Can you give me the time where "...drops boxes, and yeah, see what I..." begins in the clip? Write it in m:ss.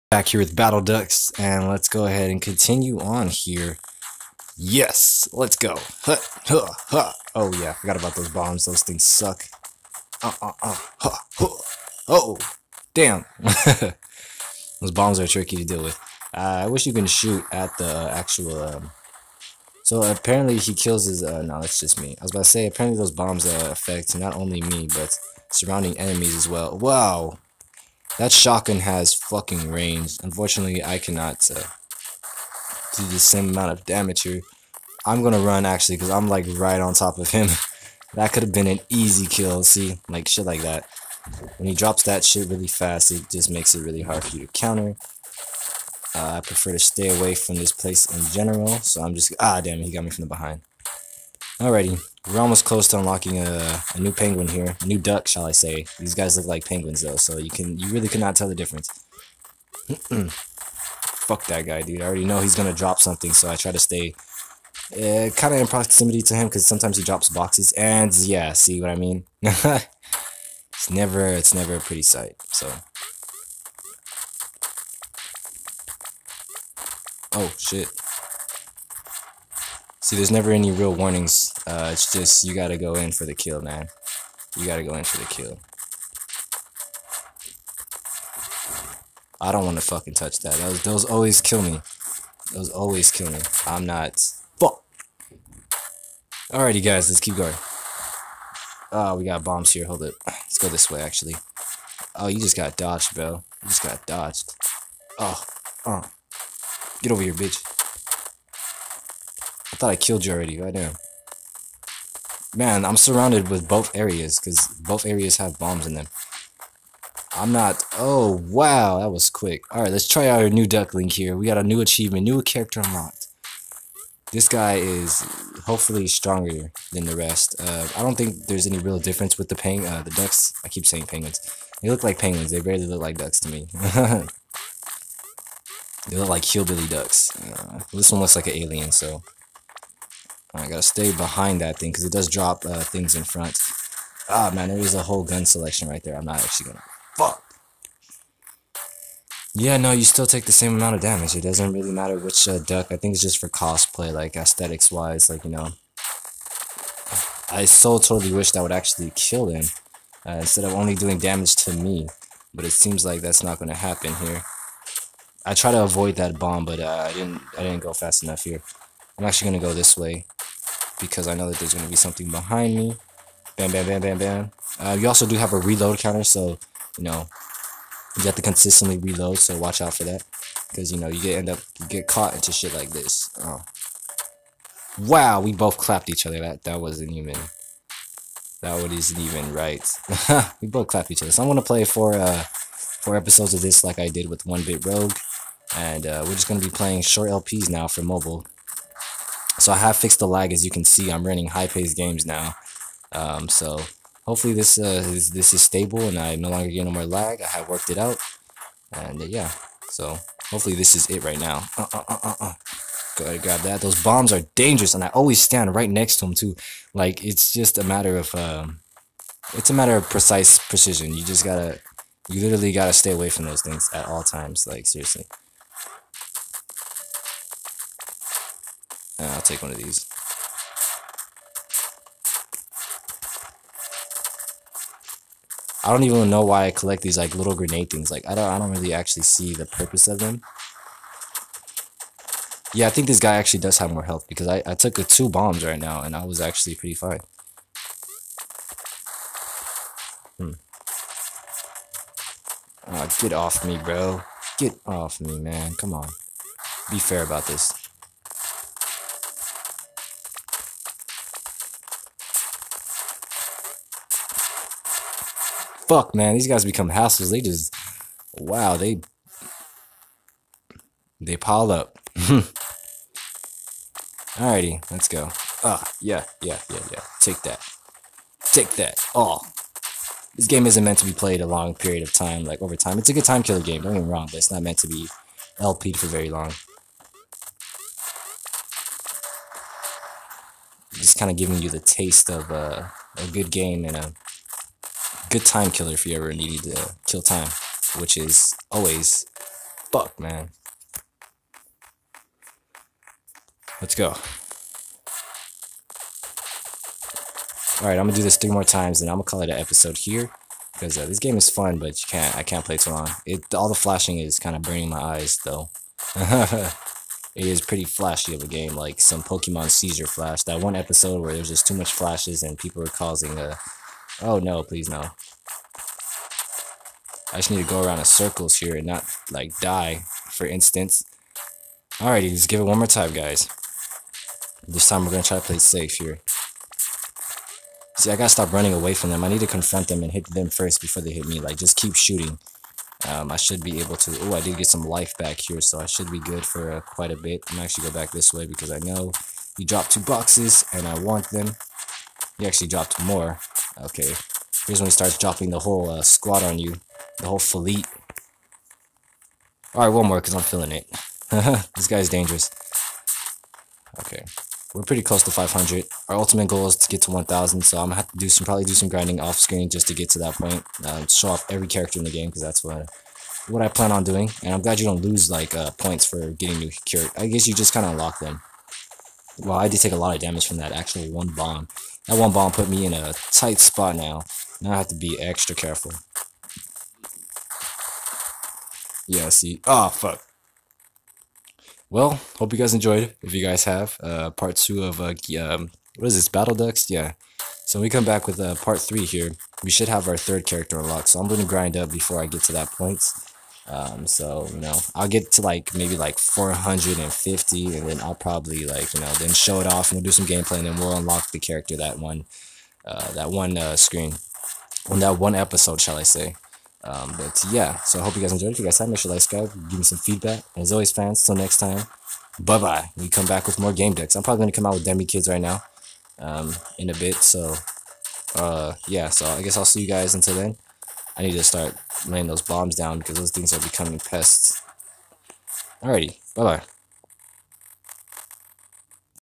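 1:07.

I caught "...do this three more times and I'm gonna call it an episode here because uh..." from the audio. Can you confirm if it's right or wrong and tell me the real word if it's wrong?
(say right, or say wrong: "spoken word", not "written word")
right.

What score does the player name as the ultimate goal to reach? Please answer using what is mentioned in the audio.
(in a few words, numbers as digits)
1,000.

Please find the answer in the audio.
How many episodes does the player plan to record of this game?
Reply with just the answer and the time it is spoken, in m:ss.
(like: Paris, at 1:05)
4, at 3:12.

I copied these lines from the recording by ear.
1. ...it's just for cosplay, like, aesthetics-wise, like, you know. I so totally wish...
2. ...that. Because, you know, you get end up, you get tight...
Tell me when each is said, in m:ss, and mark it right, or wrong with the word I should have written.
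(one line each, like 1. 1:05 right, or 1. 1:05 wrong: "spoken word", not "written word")
1. 2:33 right
2. 3:00 wrong: "caught", not "tight".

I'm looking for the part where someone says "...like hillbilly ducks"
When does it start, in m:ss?
2:16.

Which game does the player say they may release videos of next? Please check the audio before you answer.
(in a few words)
Demi Kids.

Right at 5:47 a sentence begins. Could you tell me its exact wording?
I'm actually go back this way because I know he dropped two boxes, and I want them.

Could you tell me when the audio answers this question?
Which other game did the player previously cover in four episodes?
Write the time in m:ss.
3:14.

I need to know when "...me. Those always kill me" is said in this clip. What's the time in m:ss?
1:31.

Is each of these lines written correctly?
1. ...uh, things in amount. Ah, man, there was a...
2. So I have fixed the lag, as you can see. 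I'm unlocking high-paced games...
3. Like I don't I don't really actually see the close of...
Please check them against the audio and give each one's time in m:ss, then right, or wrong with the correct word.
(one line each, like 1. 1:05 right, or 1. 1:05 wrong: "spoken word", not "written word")
1. 2:22 wrong: "front", not "amount"
2. 3:19 wrong: "running", not "unlocking"
3. 3:58 wrong: "purpose", not "close".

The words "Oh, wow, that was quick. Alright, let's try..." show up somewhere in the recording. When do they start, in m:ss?
1:57.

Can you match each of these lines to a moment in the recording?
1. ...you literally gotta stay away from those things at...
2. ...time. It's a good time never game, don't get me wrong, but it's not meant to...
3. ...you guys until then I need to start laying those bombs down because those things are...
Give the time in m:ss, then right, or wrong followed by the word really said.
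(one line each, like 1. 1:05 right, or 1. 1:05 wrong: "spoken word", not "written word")
1. 3:42 right
2. 4:42 wrong: "killer", not "never"
3. 7:09 right.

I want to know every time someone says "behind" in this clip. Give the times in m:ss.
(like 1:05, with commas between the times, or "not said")
0:50, 2:21, 2:52.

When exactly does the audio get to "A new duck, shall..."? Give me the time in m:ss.
0:54.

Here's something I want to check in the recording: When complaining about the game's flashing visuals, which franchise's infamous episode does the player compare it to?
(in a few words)
Pokemon.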